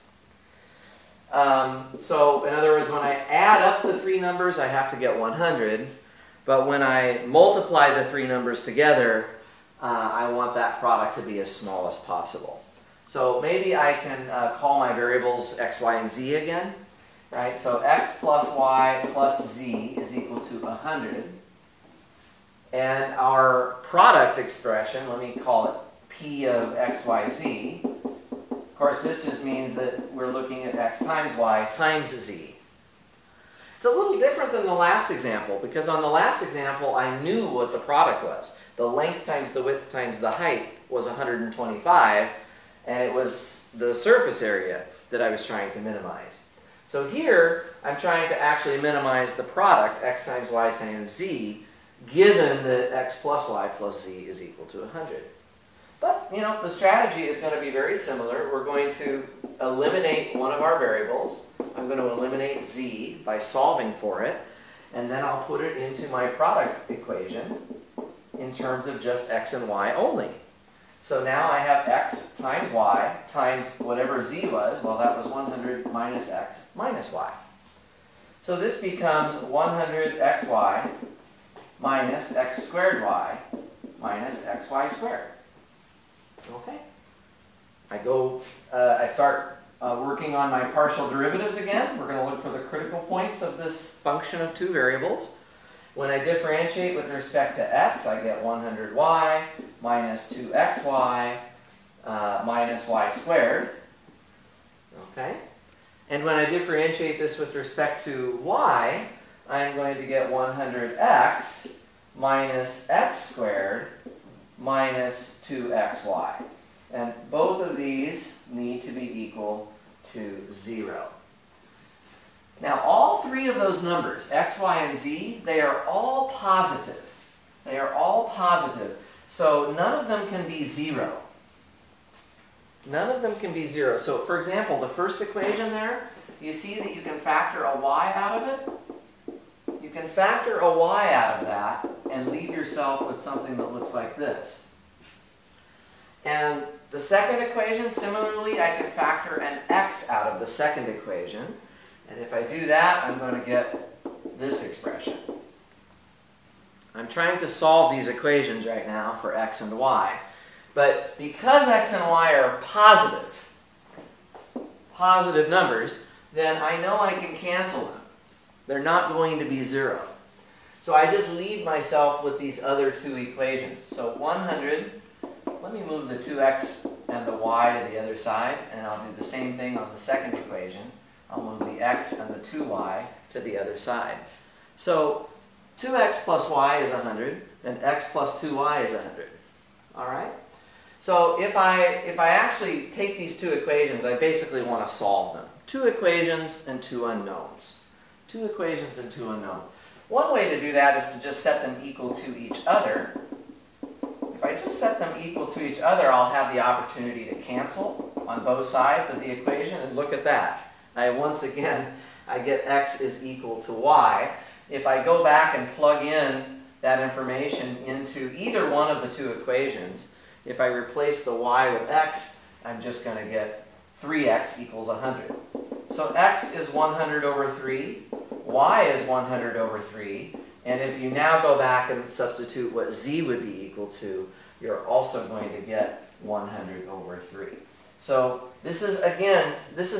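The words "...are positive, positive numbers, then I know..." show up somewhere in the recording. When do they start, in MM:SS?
02:42.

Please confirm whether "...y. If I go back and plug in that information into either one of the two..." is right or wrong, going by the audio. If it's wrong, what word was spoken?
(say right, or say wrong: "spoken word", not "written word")
right.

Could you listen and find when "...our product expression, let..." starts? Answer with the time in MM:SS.
00:23.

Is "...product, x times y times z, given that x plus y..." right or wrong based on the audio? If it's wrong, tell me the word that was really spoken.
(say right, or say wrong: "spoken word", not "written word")
right.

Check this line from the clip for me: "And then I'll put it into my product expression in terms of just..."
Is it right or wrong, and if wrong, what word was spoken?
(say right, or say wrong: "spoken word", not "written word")
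wrong: "equation", not "expression".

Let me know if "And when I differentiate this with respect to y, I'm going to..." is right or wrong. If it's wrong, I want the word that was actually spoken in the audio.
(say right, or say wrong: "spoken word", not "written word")
right.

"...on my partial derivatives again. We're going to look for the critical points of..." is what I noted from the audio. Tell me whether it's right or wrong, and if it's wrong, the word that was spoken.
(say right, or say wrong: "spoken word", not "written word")
right.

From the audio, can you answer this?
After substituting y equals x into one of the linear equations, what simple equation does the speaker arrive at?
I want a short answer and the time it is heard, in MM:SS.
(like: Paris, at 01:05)
3x = 100, at 03:44.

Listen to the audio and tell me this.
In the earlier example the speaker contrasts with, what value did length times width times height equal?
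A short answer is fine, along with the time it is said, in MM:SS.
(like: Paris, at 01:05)
125, at 00:41.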